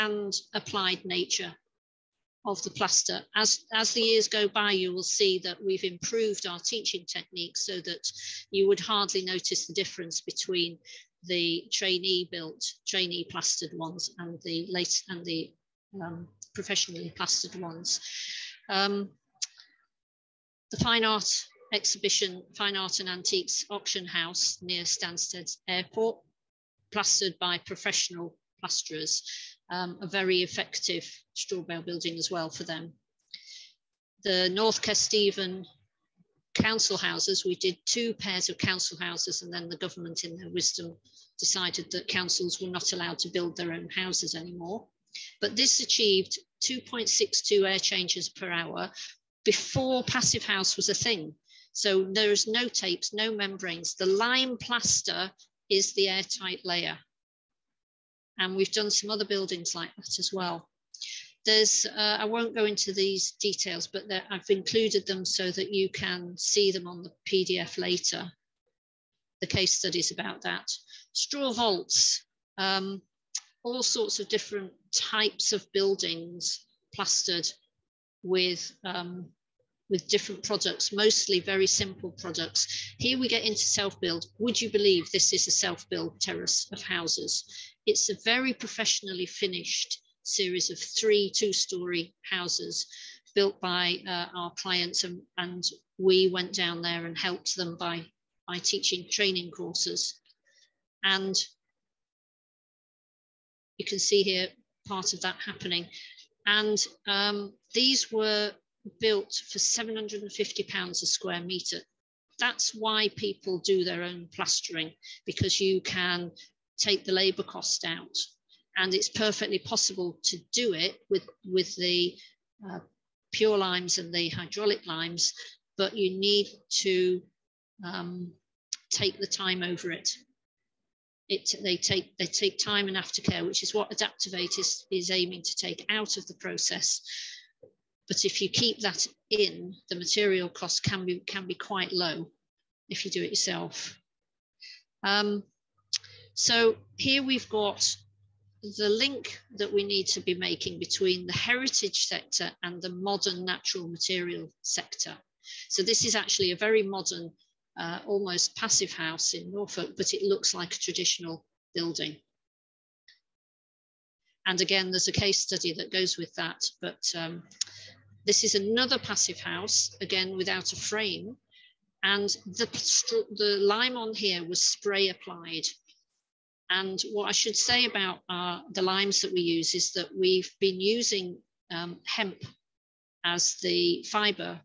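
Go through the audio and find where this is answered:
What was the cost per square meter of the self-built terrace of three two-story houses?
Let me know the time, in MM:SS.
01:49.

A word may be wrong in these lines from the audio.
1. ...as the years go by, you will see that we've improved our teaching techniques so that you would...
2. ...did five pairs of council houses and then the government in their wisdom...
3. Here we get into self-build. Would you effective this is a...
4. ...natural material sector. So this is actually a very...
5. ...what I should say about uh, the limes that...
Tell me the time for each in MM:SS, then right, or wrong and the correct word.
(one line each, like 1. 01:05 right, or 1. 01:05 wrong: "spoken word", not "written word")
1. 00:03 right
2. 00:37 wrong: "two", not "five"
3. 01:22 wrong: "believe", not "effective"
4. 02:33 right
5. 02:57 right.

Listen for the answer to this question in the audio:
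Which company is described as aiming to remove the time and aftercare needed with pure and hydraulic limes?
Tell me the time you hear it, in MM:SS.
02:13.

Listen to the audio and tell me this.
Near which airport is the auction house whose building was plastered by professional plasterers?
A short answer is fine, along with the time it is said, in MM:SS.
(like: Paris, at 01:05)
Stansted Airport, at 00:24.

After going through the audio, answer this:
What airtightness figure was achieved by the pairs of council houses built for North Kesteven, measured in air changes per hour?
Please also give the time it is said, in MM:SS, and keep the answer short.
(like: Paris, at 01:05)
2.62, at 00:46.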